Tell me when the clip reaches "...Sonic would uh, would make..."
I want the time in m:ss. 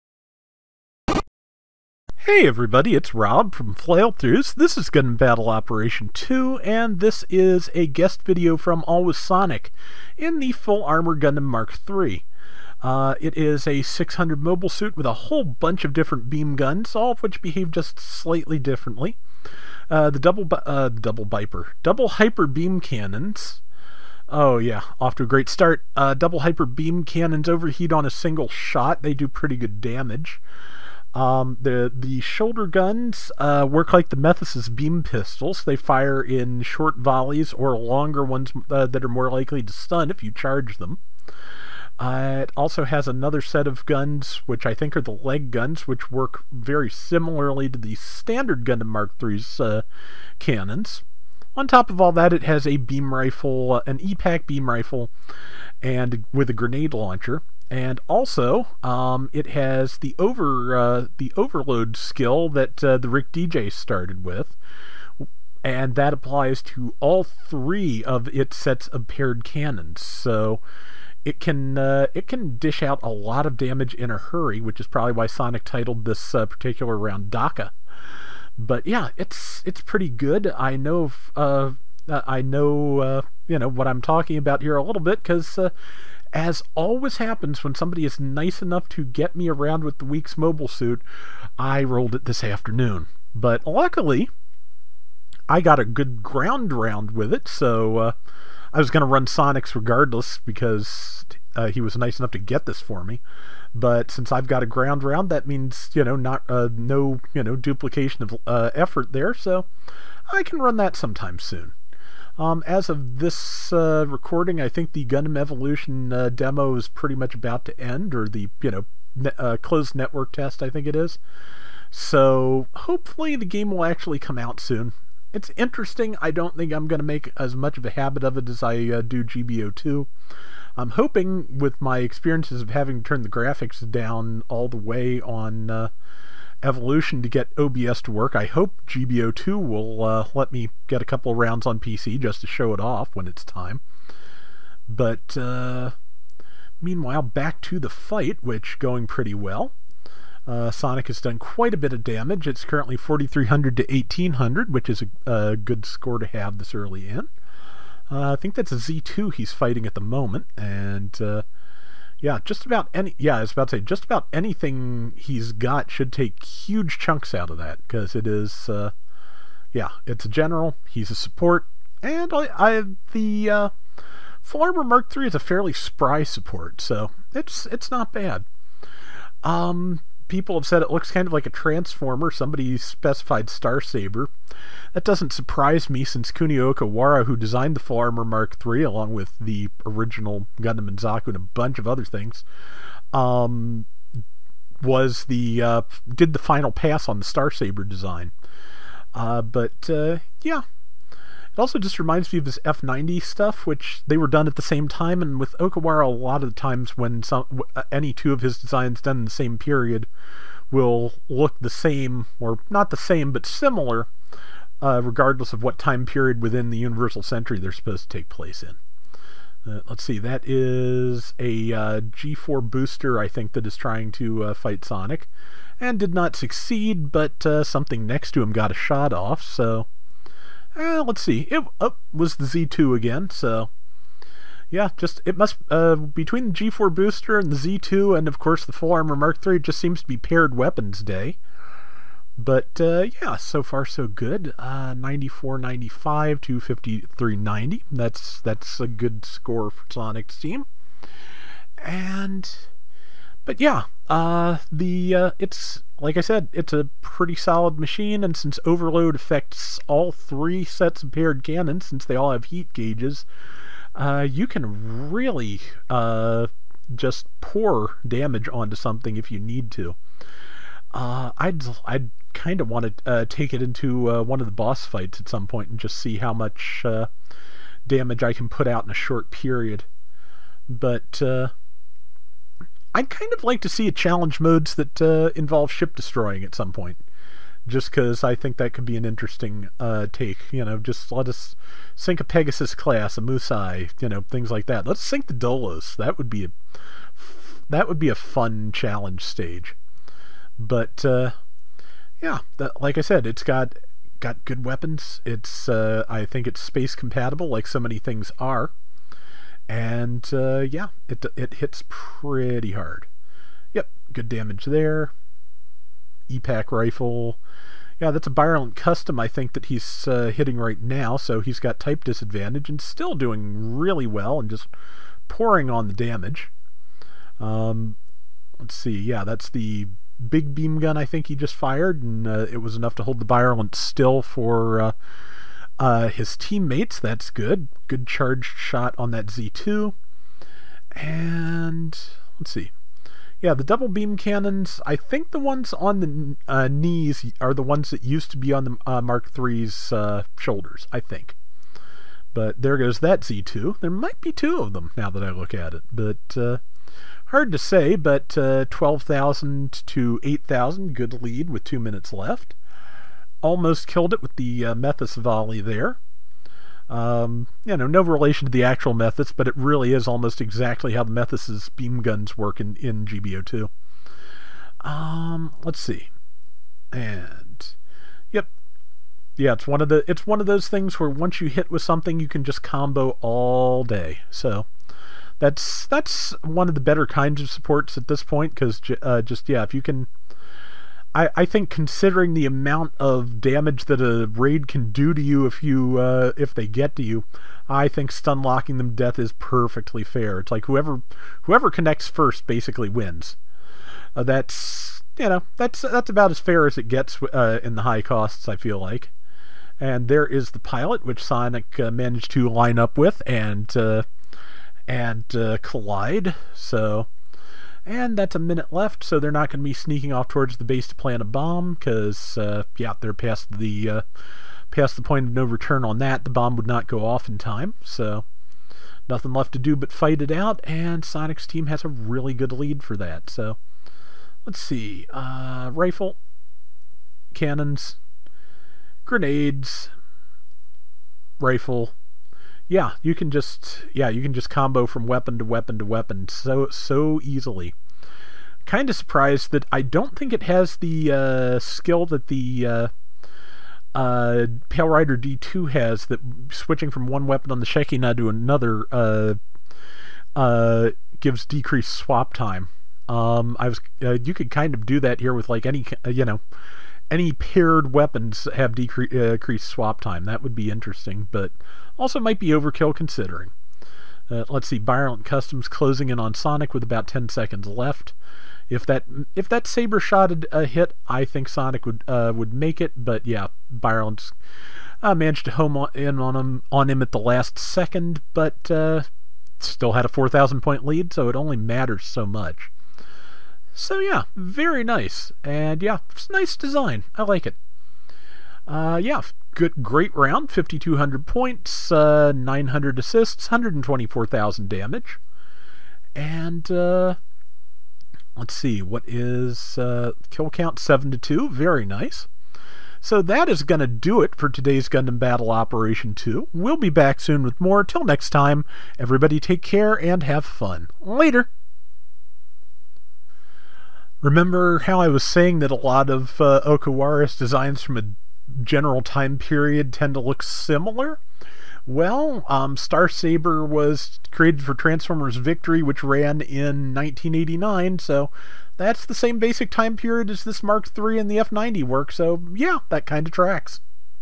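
8:01.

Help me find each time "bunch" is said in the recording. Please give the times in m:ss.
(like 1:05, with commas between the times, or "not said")
0:15, 3:11.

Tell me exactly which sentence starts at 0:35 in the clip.
They fire in short volleys or longer ones uh, that are more likely to stun if you charge them.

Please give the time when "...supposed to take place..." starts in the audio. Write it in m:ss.
3:37.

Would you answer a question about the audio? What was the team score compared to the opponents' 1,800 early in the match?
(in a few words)
4,300.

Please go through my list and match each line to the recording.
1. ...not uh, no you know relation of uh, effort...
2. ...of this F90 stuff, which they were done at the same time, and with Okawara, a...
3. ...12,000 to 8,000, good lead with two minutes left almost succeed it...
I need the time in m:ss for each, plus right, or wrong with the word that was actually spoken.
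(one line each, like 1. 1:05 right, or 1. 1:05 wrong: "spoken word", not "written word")
1. 1:46 wrong: "duplication", not "relation"
2. 3:22 right
3. 5:58 wrong: "killed", not "succeed".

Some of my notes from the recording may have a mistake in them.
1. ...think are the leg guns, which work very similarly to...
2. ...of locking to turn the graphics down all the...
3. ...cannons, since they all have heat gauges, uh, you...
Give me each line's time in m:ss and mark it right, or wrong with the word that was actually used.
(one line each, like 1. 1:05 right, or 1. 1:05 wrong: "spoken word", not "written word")
1. 0:44 right
2. 2:12 wrong: "having", not "locking"
3. 4:21 right.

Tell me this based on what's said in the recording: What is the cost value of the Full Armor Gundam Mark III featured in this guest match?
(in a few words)
600.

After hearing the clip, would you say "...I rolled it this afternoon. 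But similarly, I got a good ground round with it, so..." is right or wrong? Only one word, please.
wrong.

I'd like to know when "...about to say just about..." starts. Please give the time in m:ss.
2:43.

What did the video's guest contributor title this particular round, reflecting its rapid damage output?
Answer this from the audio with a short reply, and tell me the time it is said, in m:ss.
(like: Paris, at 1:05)
Daka, at 1:17.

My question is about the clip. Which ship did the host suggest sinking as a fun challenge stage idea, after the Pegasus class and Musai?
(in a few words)
the Dolos.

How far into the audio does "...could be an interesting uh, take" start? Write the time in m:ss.
4:48.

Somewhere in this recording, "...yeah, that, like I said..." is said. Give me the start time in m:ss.
5:02.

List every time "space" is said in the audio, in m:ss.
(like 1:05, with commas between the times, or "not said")
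5:06.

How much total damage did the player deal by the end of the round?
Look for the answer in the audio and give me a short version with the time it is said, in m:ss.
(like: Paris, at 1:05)
124,000, at 8:23.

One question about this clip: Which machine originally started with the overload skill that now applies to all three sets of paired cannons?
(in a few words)
Rick Dijeh.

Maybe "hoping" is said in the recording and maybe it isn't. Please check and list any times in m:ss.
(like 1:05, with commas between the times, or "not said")
2:10.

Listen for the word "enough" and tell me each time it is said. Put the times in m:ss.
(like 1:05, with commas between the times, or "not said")
1:28, 1:42, 5:32.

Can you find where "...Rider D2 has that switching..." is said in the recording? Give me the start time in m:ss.
7:34.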